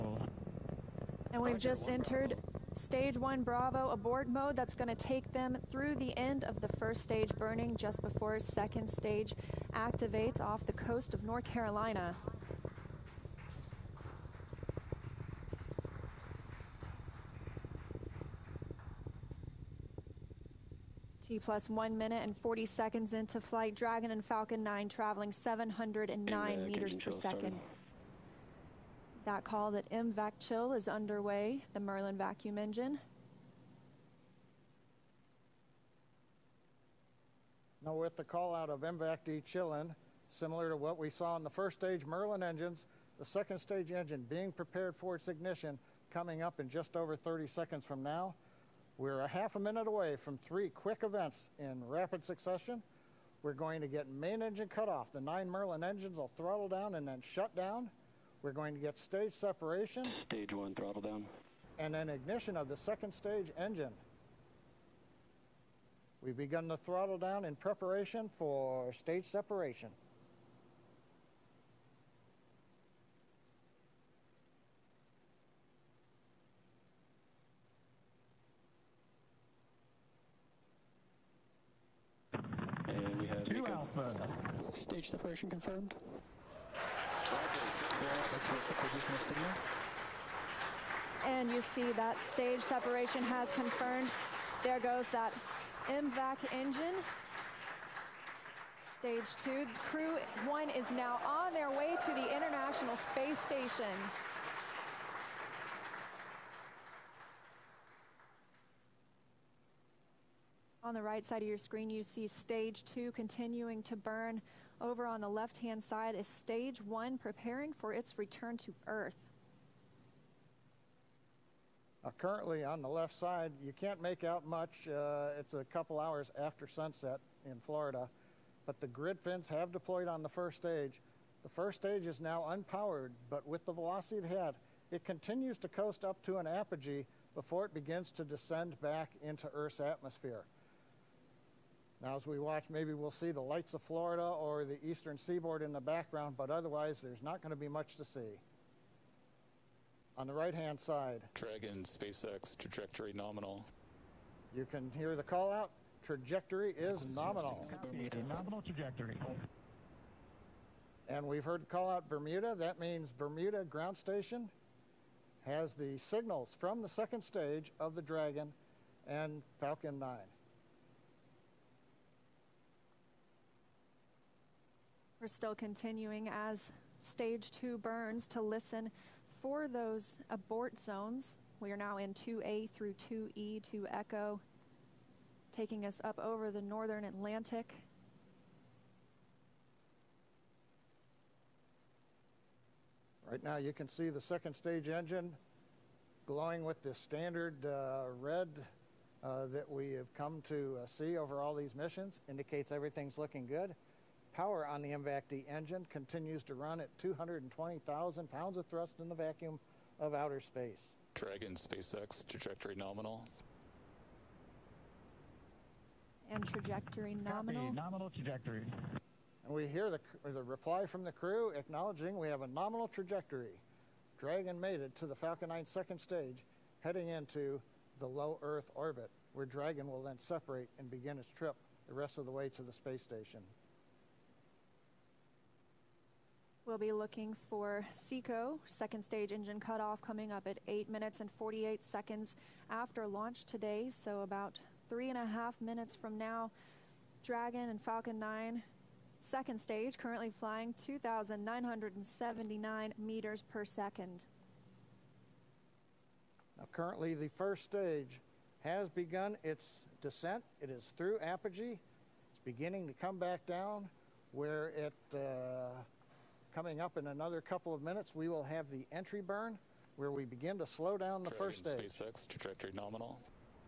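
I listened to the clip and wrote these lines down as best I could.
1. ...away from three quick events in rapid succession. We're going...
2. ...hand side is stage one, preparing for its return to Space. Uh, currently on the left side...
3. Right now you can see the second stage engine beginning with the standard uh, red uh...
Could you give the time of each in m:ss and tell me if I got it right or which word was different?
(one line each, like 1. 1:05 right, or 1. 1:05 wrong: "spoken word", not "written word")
1. 0:49 right
2. 1:55 wrong: "Earth", not "Space"
3. 3:13 wrong: "glowing", not "beginning".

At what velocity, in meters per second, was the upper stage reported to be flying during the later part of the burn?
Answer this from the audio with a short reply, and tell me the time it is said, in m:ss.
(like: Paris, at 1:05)
2,979, at 4:10.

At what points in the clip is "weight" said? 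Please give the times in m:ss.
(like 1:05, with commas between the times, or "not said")
not said.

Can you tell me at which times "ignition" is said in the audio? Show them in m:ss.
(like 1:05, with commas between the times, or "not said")
0:45, 1:02.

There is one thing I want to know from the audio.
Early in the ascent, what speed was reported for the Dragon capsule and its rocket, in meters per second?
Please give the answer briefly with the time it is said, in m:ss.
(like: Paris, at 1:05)
709, at 0:25.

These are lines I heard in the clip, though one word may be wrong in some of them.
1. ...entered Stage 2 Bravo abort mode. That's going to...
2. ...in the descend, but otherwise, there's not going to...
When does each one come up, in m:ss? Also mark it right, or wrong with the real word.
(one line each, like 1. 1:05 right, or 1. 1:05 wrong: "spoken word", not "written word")
1. 0:01 wrong: "1", not "2"
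2. 2:25 wrong: "background", not "descend".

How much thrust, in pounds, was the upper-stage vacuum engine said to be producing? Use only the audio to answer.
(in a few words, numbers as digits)
220,000 pounds.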